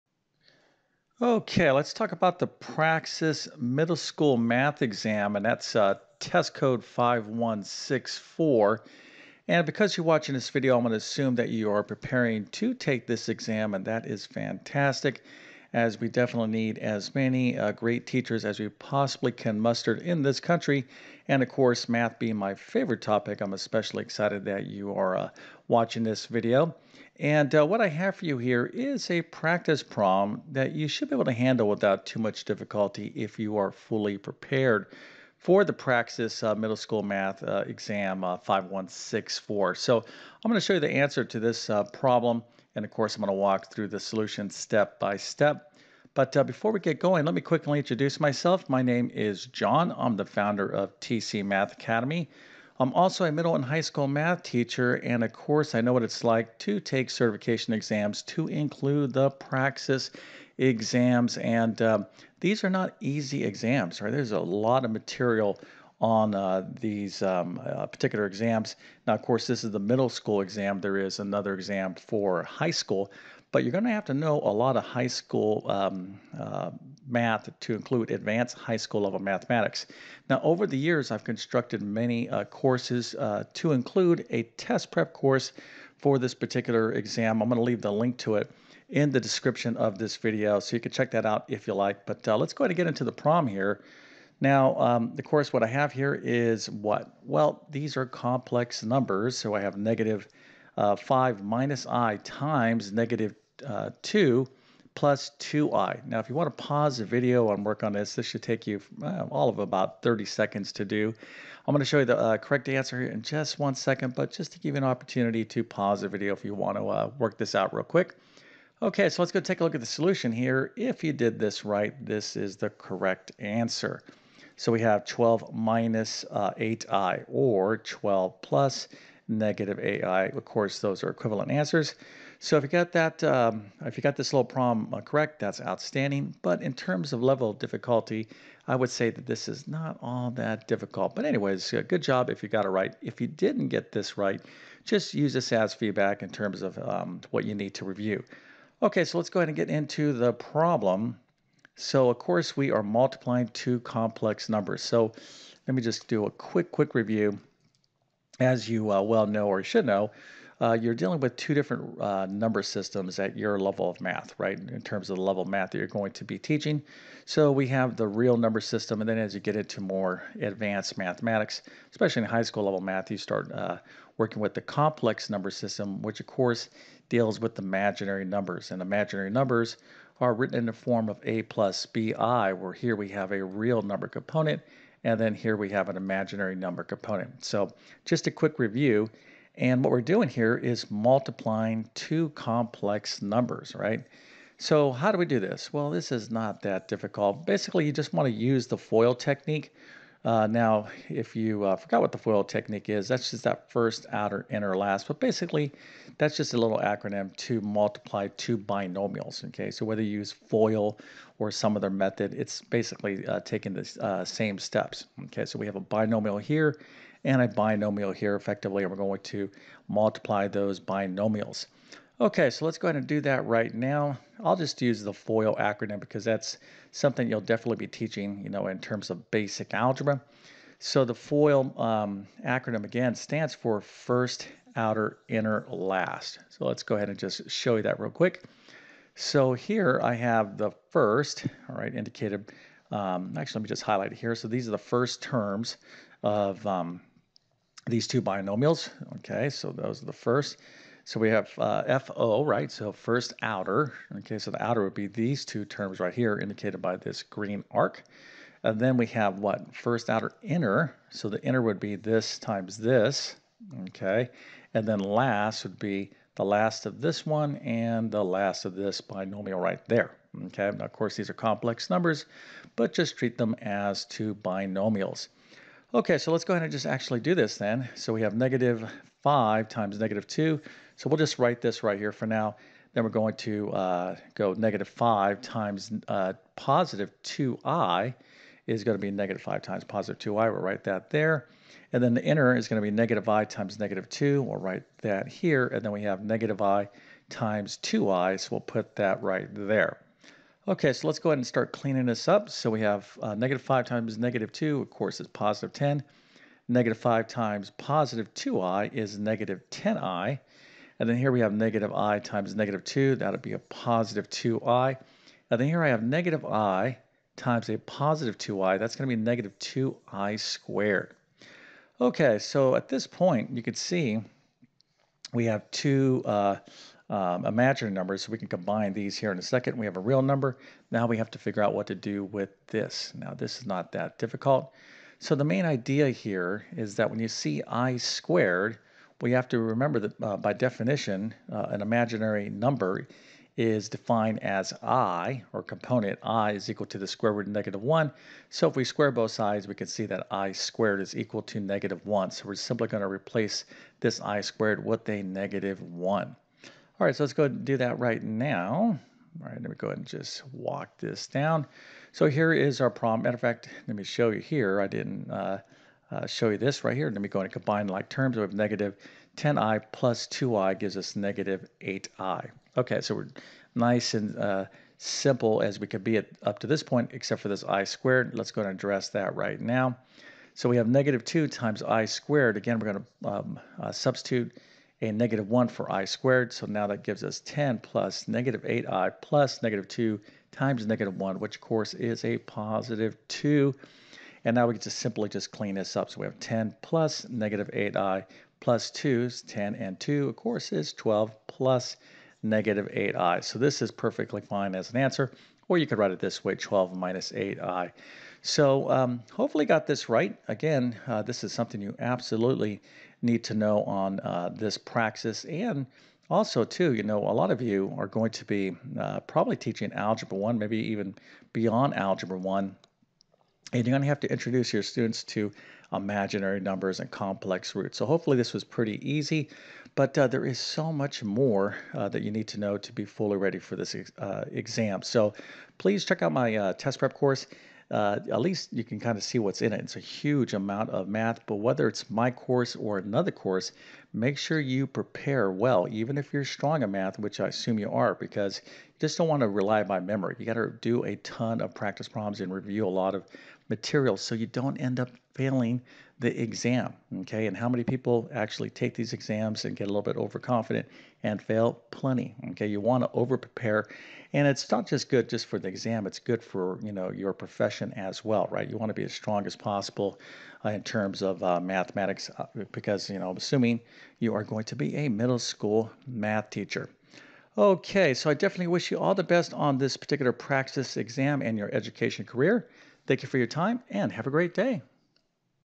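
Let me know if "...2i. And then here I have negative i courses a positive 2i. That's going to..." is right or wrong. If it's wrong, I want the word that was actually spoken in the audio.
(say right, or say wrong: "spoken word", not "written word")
wrong: "times", not "courses".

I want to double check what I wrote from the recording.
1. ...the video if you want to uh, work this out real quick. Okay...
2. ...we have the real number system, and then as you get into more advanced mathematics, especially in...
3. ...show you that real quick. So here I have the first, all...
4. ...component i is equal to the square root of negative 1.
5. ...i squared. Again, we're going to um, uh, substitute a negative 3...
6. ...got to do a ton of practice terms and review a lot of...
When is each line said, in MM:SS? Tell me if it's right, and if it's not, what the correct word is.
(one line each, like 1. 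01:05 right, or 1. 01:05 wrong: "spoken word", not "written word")
1. 01:56 right
2. 02:47 right
3. 03:57 right
4. 05:45 right
5. 06:21 wrong: "1", not "3"
6. 07:30 wrong: "problems", not "terms".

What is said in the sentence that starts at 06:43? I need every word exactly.
So this is perfectly fine as an answer, or you could write it this way, 12 minus 8i.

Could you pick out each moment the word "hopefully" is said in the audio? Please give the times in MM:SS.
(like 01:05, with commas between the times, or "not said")
06:49, 07:08.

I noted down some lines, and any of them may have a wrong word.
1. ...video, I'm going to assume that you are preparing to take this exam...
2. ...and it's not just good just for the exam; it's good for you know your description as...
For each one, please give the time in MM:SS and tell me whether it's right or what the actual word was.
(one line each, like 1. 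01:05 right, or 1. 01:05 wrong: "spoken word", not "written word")
1. 00:10 right
2. 07:44 wrong: "profession", not "description".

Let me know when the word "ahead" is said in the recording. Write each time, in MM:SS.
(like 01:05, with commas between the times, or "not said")
01:32, 02:29, 03:42, 03:56, 04:36, 05:01, 05:59.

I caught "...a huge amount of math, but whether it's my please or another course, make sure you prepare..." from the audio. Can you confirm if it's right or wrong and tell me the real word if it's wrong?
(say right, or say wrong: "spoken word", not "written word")
wrong: "course", not "please".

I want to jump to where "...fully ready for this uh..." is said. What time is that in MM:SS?
07:13.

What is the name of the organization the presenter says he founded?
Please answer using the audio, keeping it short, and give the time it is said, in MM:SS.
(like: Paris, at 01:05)
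TC Math Academy, at 00:51.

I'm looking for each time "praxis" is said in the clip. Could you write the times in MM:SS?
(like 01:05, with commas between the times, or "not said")
00:02, 00:35, 00:59, 06:54.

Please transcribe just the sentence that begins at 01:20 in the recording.
Now, over the years, I've constructed many uh, courses uh, to include a test prep course for this particular exam.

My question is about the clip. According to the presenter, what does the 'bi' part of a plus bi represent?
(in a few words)
imaginary number component.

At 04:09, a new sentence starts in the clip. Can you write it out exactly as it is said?
Okay, so those are the first.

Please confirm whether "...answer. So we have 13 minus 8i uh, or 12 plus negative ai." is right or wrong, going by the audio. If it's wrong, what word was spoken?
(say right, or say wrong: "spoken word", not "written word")
wrong: "12", not "13".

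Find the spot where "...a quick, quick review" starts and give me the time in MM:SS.
02:36.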